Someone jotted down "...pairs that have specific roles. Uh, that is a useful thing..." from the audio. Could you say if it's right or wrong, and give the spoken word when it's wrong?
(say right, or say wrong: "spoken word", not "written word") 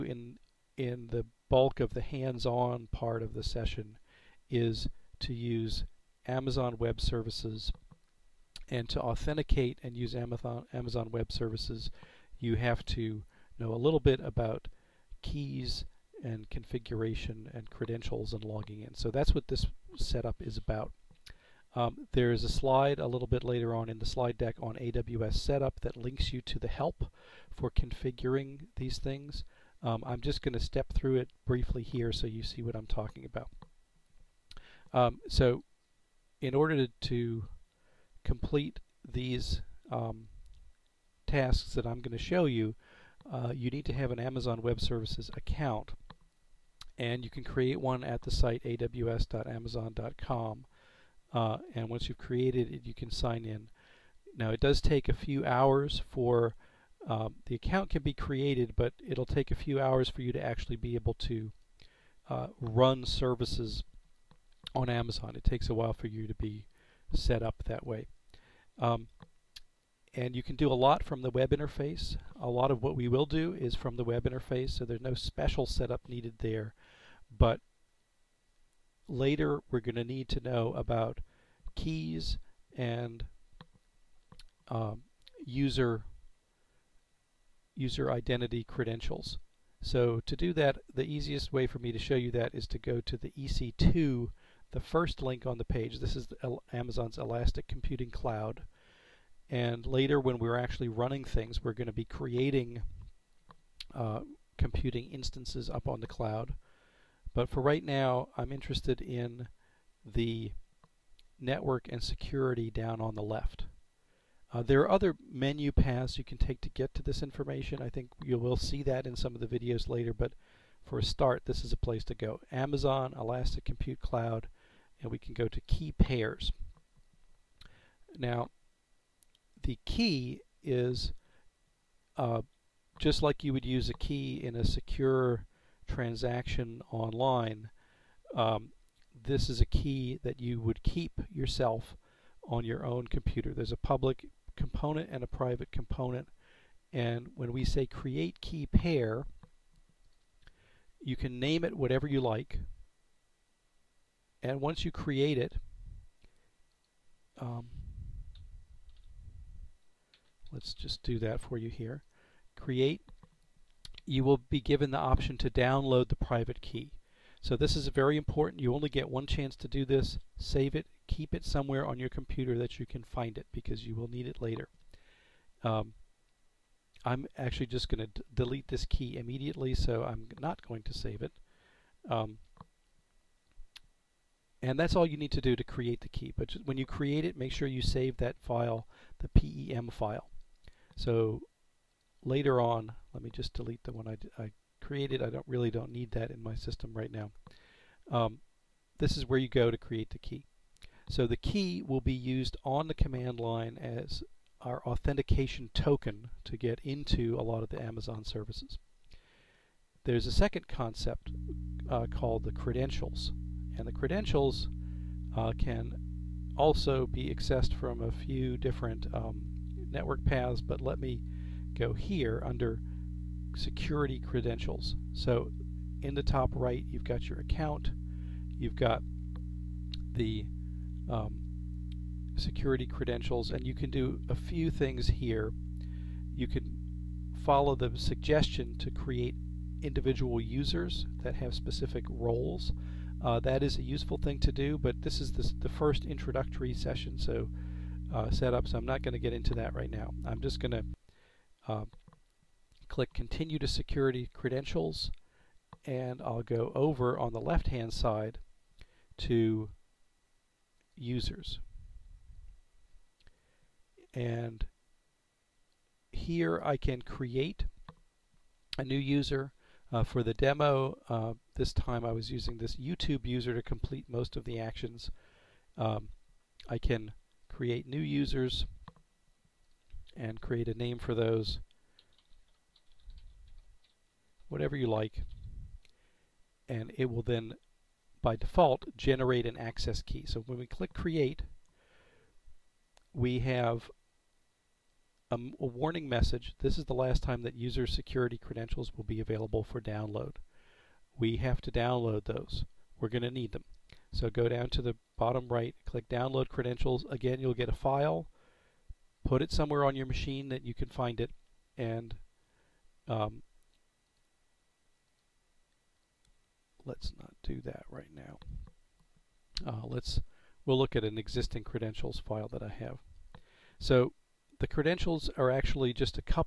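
wrong: "users", not "pairs".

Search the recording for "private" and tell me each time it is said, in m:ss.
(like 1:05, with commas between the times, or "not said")
2:25, 2:46.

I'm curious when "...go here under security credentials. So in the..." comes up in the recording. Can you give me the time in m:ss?
3:41.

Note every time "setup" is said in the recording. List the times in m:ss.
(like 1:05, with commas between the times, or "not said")
0:19, 0:25, 1:15, 4:08.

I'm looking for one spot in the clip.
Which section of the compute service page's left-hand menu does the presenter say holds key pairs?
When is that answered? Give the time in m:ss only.
1:51.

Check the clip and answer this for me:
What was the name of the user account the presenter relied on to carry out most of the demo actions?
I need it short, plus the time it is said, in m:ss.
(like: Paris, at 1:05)
YouTube, at 4:32.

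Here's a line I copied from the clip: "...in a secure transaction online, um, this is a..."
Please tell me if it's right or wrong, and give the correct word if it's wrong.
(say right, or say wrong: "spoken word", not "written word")
right.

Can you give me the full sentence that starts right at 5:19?
Uh, let's we'll look at an existing credentials file that I have.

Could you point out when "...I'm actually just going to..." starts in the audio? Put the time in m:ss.
2:57.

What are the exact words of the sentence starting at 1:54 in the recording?
Uh, there are other menu paths you can take to get to this information.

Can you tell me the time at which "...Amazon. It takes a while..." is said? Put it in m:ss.
1:04.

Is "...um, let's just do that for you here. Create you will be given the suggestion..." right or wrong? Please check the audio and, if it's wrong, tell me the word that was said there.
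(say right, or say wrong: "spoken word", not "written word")
wrong: "option", not "suggestion".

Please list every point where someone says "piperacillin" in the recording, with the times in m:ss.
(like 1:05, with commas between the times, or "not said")
not said.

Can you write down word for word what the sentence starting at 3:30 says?
There's a second concept uh, called the credentials.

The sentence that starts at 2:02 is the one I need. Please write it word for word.
Amazon, Elastic Compute Cloud, and we can go to key pairs.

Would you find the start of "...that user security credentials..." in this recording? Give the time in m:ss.
4:57.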